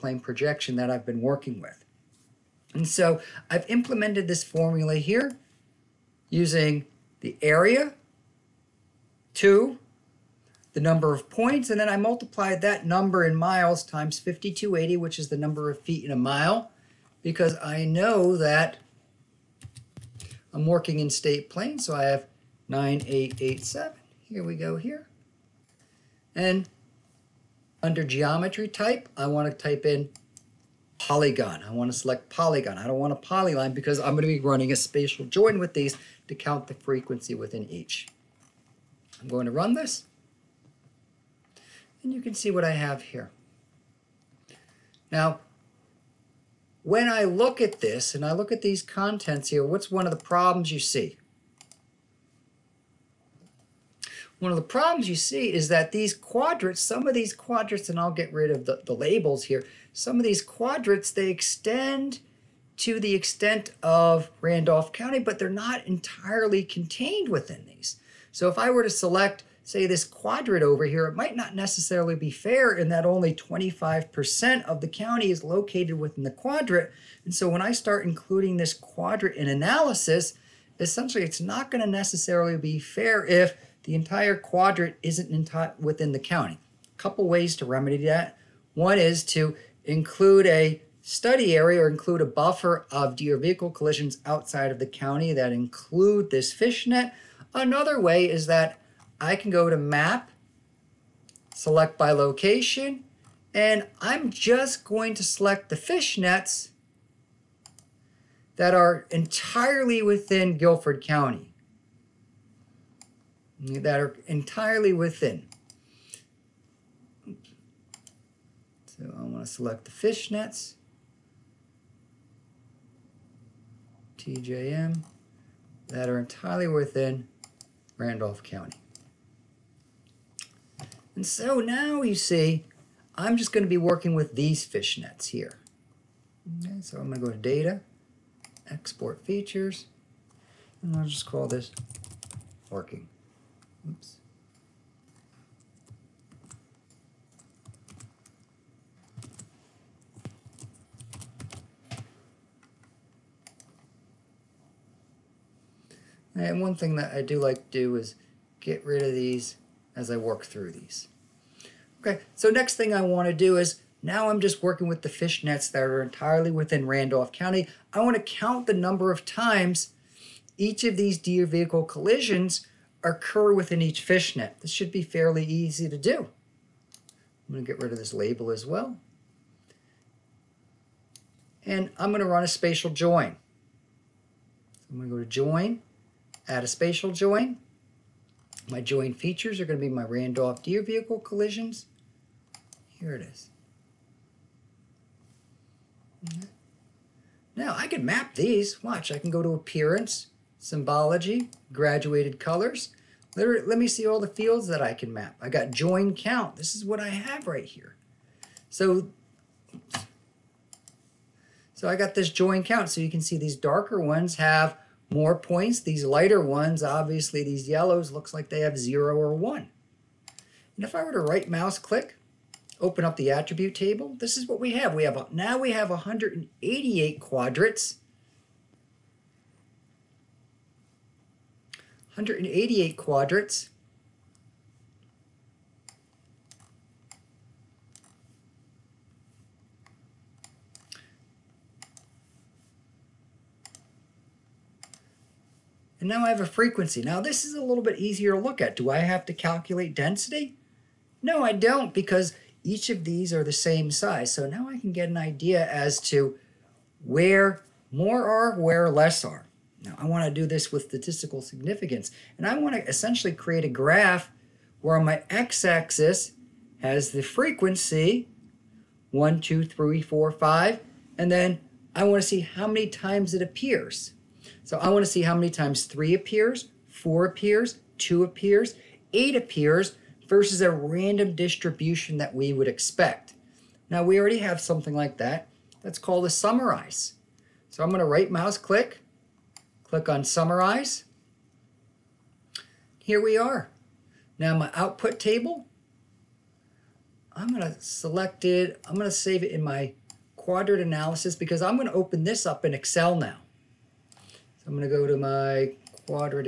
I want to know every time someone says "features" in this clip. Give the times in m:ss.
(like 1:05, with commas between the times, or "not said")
2:19, 3:09.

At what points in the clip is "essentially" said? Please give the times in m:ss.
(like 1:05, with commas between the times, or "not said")
1:20, 4:22.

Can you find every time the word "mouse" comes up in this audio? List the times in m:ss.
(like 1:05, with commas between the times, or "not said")
3:41, 4:48.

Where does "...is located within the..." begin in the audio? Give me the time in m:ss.
1:15.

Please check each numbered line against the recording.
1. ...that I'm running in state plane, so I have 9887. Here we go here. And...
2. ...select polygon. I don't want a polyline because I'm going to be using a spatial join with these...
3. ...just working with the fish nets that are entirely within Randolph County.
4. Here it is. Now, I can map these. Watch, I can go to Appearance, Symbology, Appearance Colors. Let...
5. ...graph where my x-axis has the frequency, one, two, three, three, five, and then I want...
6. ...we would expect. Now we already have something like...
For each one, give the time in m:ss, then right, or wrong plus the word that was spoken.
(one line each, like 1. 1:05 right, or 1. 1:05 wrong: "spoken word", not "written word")
1. 0:18 wrong: "working", not "running"
2. 0:31 wrong: "running", not "using"
3. 2:44 right
4. 3:12 wrong: "Graduated", not "Appearance"
5. 4:23 wrong: "four", not "three"
6. 4:42 right.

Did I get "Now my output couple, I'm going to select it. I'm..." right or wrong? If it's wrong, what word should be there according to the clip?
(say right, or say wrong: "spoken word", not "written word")
wrong: "table", not "couple".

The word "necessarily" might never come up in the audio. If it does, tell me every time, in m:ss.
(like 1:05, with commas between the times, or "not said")
1:11, 1:21.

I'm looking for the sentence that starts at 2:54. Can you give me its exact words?
This should be fairly easy to do.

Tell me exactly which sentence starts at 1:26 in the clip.
A couple ways to remedy that.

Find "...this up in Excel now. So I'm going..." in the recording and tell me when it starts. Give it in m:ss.
5:02.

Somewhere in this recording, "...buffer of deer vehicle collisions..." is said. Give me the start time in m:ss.
1:32.